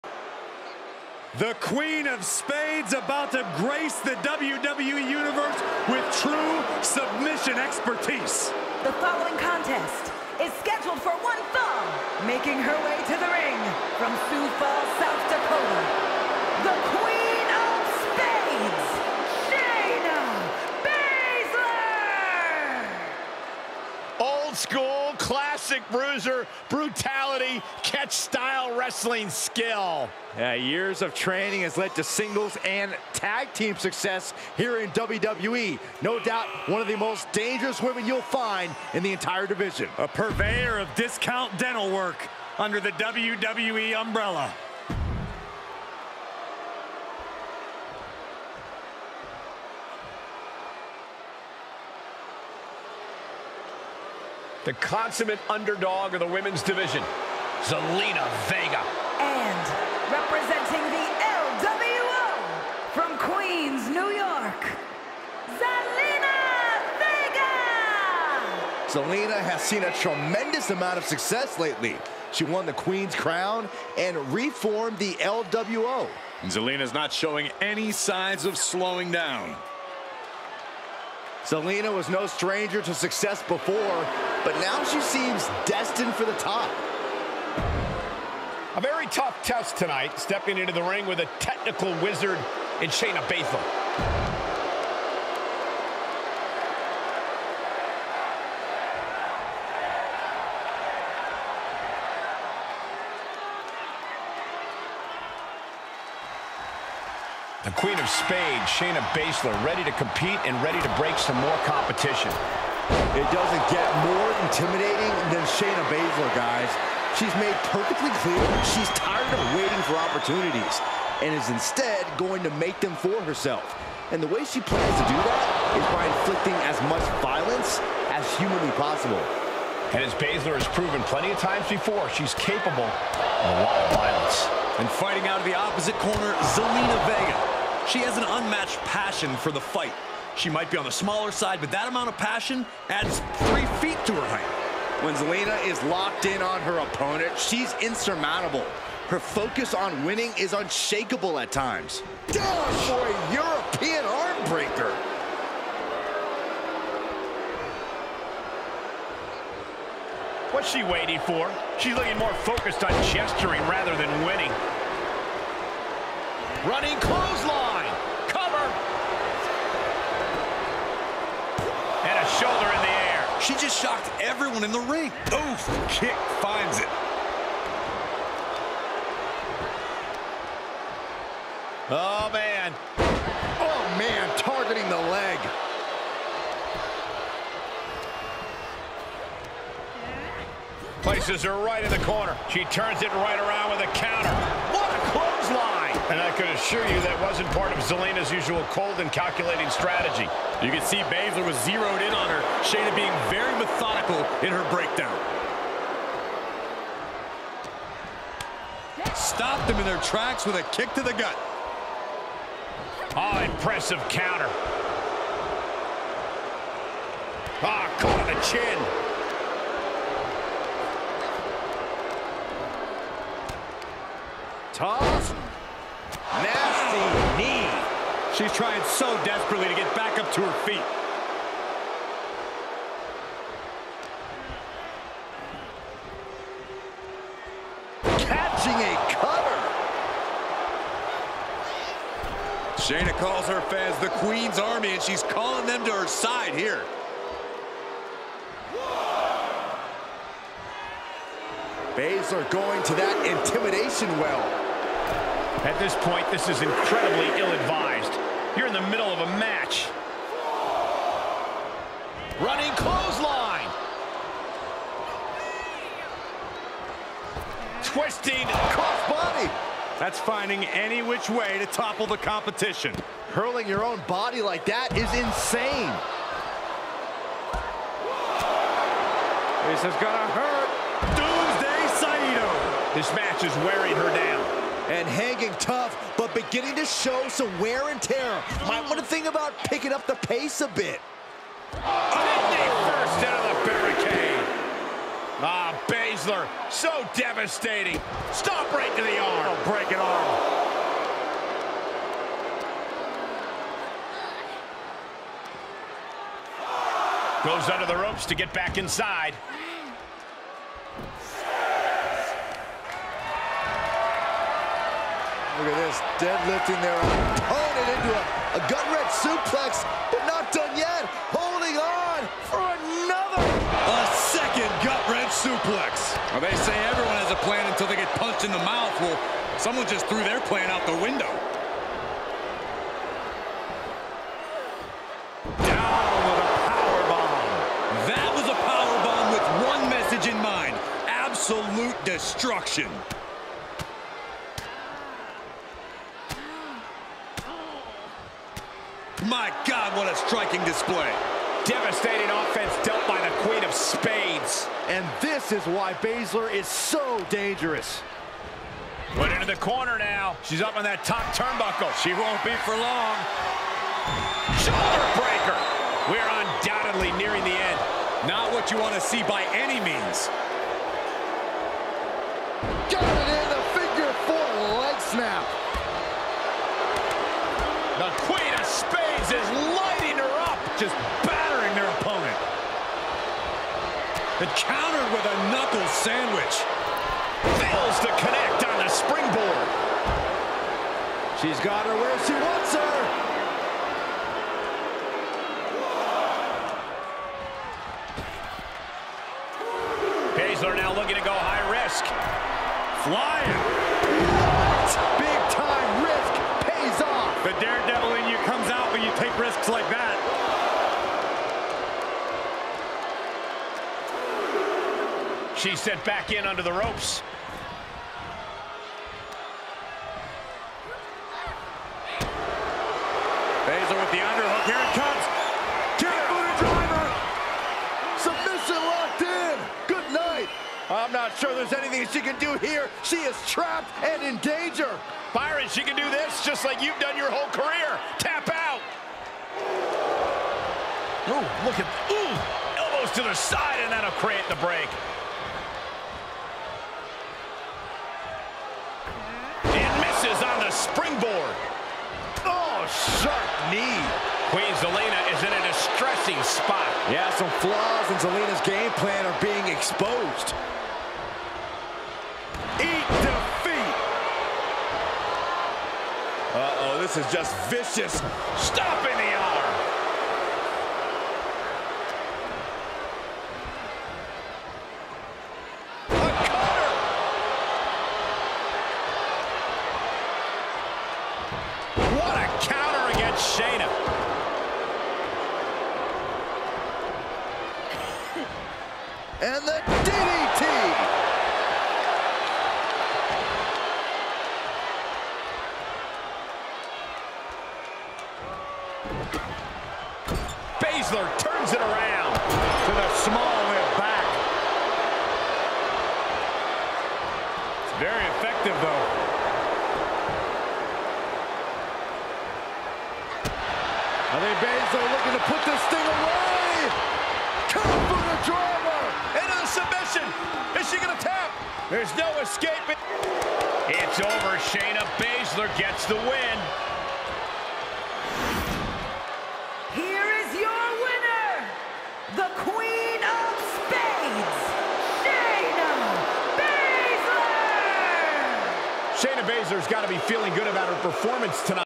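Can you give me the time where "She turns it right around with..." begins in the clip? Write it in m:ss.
3:12.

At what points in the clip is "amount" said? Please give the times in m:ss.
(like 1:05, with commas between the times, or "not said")
1:10, 2:21.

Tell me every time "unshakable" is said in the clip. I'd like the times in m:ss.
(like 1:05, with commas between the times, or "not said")
2:30.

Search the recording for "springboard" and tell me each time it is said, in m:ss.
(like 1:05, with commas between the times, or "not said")
6:28, 7:30.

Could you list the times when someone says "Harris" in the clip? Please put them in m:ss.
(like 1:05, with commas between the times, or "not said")
not said.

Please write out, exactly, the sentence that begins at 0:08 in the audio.
The following contest is scheduled for one thumb.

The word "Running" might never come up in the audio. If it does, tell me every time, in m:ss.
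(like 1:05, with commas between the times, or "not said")
2:46, 4:22.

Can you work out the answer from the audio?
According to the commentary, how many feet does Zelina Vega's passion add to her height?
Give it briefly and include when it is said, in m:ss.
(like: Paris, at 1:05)
3, at 2:23.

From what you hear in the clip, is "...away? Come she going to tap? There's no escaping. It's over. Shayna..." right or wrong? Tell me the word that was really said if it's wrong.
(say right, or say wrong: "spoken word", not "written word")
right.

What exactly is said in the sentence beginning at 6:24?
and countered with a knuckle sandwich.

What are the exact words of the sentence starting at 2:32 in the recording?
Down for a European arm breaker.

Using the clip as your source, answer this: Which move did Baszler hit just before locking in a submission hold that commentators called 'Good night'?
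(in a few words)
Kick driver.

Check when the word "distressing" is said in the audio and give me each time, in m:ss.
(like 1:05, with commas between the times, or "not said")
7:35.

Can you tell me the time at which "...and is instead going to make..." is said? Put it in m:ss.
2:01.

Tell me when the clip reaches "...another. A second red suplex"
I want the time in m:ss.
5:22.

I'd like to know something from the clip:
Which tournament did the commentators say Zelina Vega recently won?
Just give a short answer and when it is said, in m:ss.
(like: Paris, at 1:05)
Queen's Crown, at 1:12.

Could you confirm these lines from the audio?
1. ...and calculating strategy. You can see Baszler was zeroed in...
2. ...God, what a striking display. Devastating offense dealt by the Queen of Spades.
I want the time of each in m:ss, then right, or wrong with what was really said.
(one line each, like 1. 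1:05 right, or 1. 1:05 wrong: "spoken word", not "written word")
1. 3:18 right
2. 5:49 right.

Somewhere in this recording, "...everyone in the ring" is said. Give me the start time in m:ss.
2:54.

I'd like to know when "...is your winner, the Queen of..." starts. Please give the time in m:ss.
8:50.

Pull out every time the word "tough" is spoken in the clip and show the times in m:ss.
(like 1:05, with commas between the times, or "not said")
1:29, 3:45, 4:45.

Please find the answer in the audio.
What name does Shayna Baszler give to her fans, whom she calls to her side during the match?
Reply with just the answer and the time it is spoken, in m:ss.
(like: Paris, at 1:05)
Queen's Army, at 4:04.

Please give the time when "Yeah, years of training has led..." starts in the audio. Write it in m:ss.
0:30.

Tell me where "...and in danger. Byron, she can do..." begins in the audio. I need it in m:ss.
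7:14.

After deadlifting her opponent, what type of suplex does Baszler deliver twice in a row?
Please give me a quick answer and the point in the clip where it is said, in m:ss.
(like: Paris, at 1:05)
gutwrench suplex, at 5:18.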